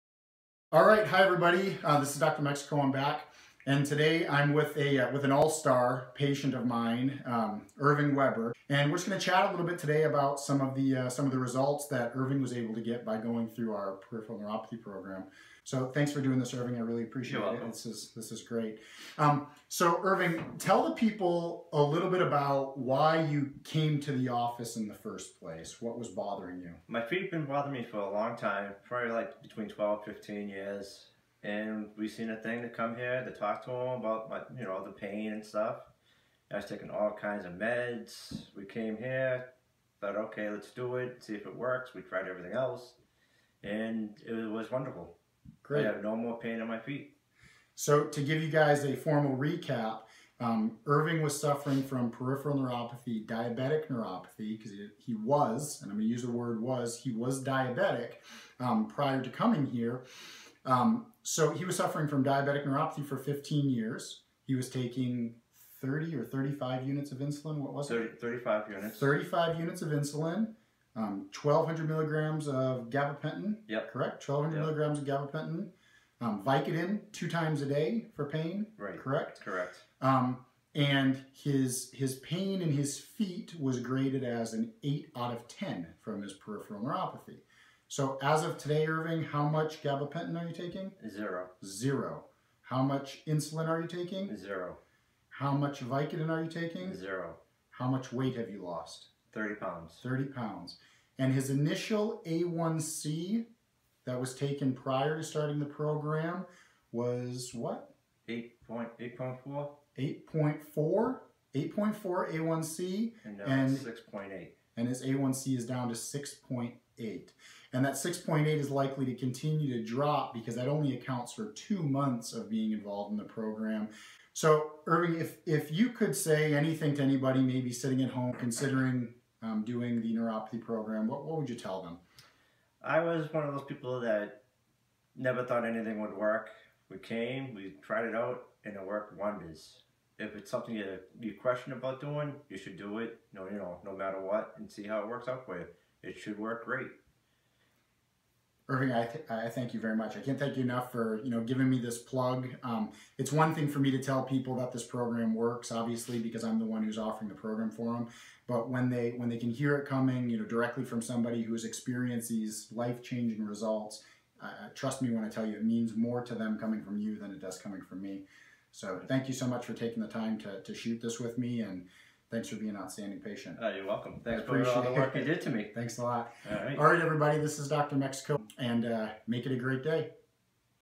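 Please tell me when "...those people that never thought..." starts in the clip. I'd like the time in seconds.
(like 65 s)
133 s.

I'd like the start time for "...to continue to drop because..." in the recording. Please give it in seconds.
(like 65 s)
119 s.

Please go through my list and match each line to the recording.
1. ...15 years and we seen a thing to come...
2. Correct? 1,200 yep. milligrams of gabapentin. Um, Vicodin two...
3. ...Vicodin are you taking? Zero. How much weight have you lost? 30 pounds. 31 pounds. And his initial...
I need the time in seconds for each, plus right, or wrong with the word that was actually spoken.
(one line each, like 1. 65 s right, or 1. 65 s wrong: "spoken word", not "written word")
1. 30 s right
2. 73 s right
3. 95 s wrong: "30", not "31".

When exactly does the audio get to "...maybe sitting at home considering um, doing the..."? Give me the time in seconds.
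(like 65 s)
127 s.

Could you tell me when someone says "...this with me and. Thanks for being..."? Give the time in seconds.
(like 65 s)
171 s.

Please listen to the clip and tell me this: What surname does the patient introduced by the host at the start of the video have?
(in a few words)
Weber.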